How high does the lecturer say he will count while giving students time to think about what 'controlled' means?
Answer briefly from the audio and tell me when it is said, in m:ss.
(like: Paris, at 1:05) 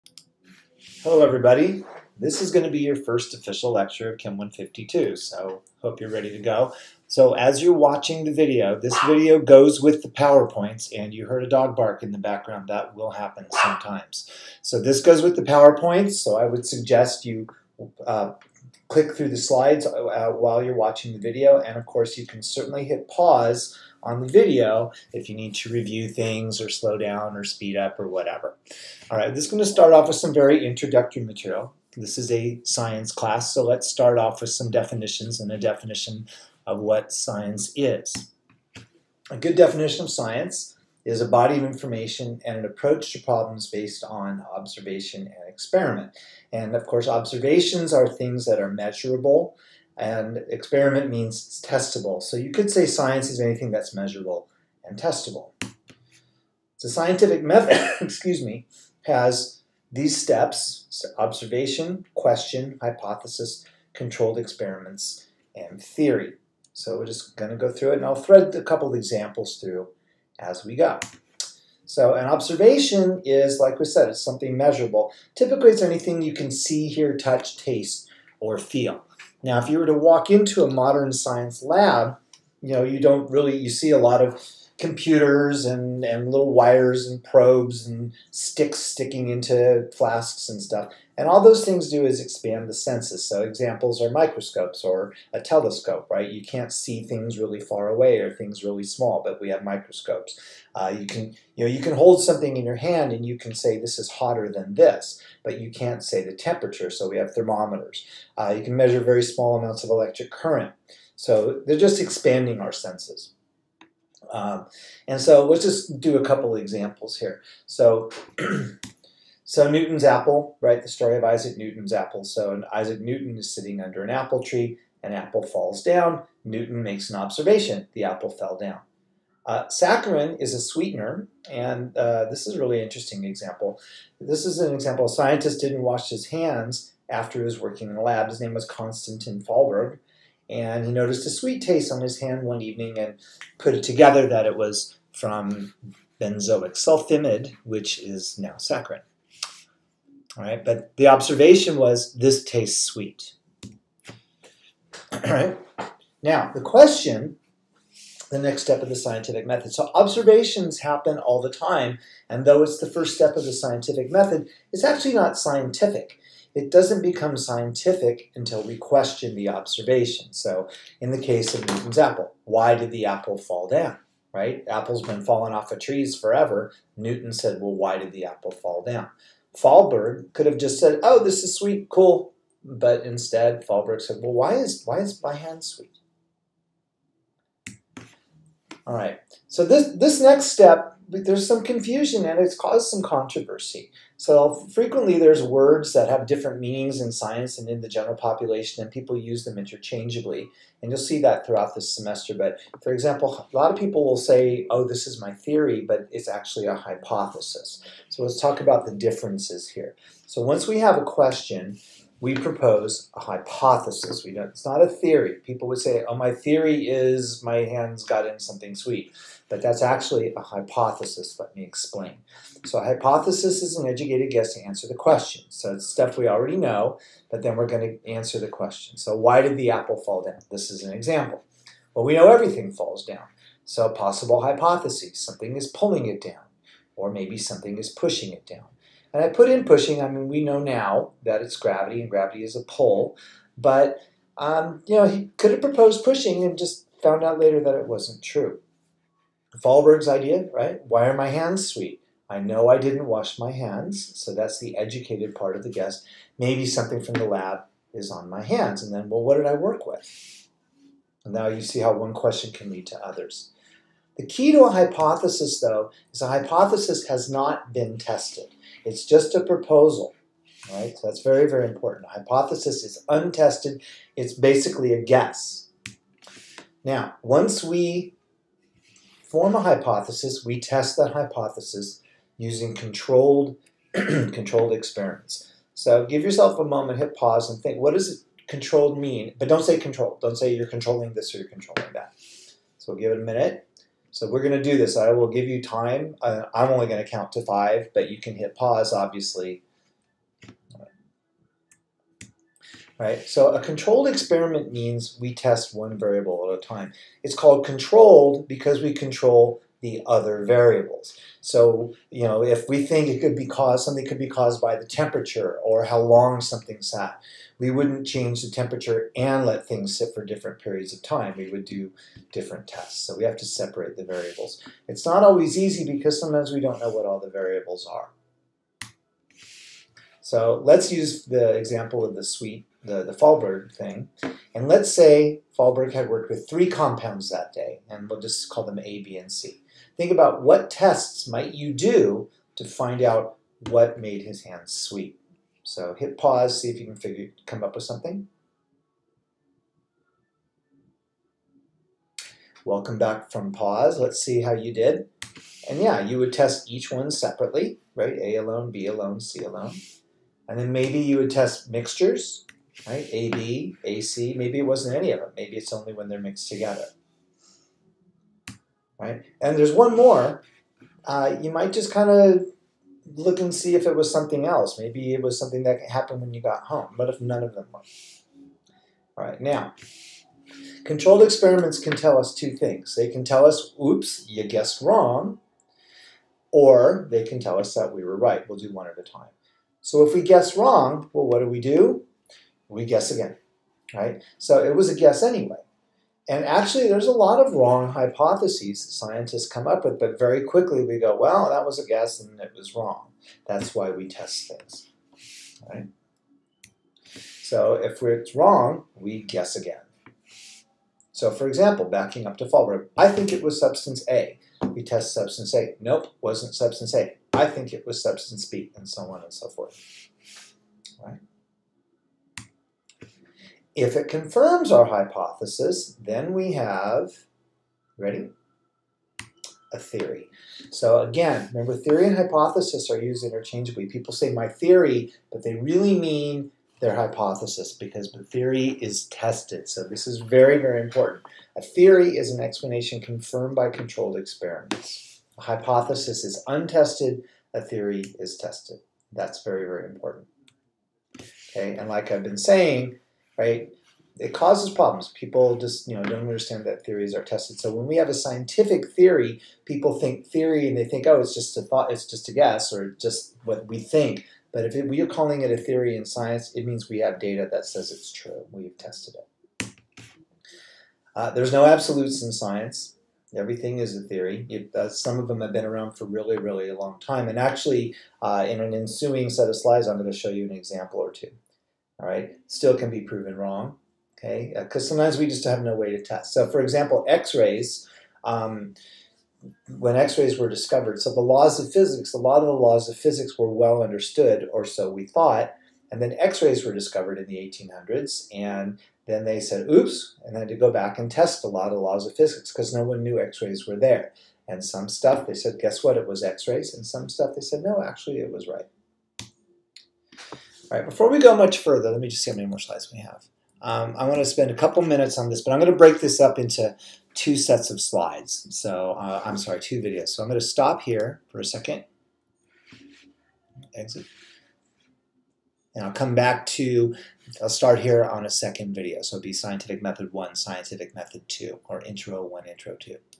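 5, at 4:57.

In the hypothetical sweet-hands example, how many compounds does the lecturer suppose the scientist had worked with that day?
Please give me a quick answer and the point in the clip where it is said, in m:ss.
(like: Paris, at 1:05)
3, at 5:36.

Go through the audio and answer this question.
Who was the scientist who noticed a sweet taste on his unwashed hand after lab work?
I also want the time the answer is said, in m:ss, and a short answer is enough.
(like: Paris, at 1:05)
Konstantin Fallberg, at 2:18.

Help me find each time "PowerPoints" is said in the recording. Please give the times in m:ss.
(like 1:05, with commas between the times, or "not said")
0:10, 0:15.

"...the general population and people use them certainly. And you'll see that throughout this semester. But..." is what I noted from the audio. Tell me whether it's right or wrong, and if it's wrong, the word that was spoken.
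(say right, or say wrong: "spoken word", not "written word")
wrong: "interchangeably", not "certainly".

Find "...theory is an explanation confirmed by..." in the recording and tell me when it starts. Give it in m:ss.
7:21.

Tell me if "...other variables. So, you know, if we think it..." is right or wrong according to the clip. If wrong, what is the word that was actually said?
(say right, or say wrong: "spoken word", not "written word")
right.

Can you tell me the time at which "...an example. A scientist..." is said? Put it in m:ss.
2:14.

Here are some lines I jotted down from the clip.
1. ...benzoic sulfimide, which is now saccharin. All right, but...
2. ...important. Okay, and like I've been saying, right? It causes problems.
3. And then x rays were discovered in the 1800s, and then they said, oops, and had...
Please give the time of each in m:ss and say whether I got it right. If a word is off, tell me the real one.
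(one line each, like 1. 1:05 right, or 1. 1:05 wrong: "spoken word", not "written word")
1. 2:26 right
2. 7:29 right
3. 8:15 right.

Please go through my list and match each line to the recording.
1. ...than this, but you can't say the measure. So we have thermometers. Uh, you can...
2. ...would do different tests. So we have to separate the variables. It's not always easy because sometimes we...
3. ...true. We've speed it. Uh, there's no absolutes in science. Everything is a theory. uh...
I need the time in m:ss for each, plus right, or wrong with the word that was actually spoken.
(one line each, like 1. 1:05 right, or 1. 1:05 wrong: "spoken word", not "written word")
1. 1:44 wrong: "temperature", not "measure"
2. 5:21 right
3. 7:48 wrong: "tested", not "speed".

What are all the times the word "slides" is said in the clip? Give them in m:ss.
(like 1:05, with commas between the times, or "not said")
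0:19, 7:59, 8:32, 8:37.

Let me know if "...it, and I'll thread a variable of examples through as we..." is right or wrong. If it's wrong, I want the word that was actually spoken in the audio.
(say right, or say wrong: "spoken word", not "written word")
wrong: "couple", not "variable".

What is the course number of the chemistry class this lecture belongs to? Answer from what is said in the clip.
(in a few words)
Chem 152.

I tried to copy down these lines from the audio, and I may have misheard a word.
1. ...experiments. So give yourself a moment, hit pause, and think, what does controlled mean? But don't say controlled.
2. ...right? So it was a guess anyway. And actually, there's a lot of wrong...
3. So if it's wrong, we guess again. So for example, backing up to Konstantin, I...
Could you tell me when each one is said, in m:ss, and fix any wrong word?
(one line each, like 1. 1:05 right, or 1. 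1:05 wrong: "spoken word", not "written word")
1. 4:44 right
2. 6:33 right
3. 6:47 wrong: "Fahlberg", not "Konstantin".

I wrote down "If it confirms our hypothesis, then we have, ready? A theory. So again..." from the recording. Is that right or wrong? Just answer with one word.
right.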